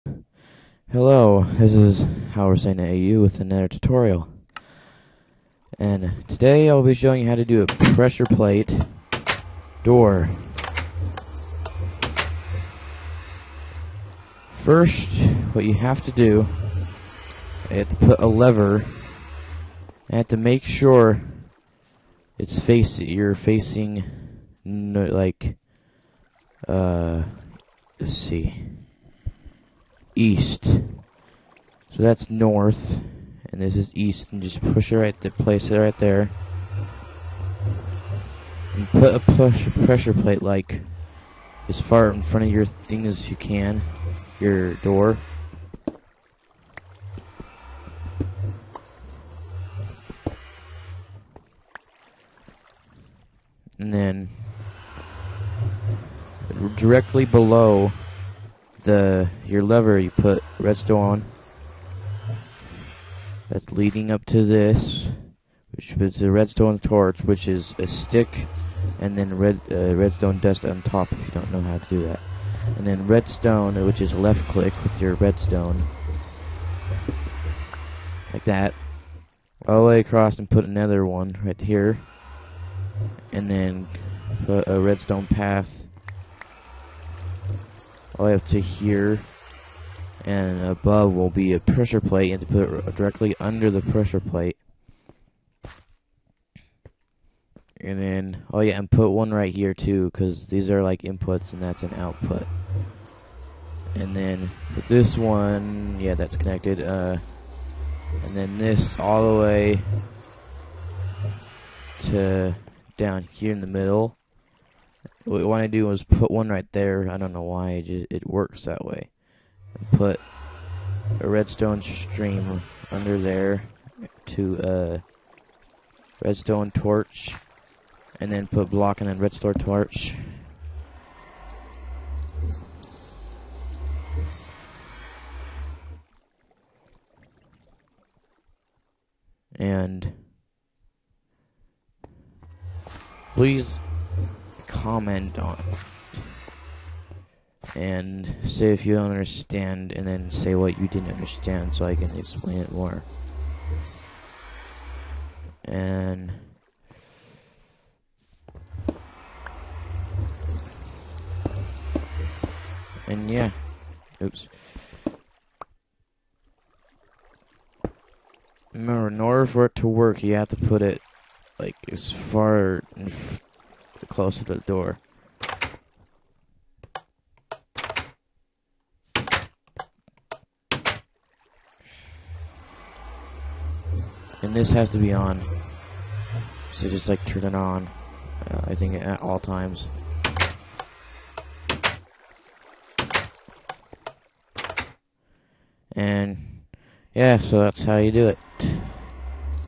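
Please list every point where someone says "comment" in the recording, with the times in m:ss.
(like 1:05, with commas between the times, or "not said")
2:24.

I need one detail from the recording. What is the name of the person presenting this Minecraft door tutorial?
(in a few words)
Howard Saying AU.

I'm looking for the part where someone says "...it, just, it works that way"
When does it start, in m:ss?
1:57.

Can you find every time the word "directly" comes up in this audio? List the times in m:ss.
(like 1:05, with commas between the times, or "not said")
0:56, 1:32.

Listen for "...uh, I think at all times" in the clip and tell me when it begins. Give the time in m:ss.
3:08.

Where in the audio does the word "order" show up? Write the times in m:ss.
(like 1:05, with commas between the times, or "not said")
2:49.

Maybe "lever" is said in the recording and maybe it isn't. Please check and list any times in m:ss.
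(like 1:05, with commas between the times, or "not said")
0:18, 0:59.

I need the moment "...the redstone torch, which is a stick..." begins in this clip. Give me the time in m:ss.
1:06.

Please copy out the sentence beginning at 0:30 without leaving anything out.
So that's north, and this is east, and just push it right there, place it right there.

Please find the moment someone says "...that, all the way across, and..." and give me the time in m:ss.
1:18.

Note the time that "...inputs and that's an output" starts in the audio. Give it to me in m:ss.
1:41.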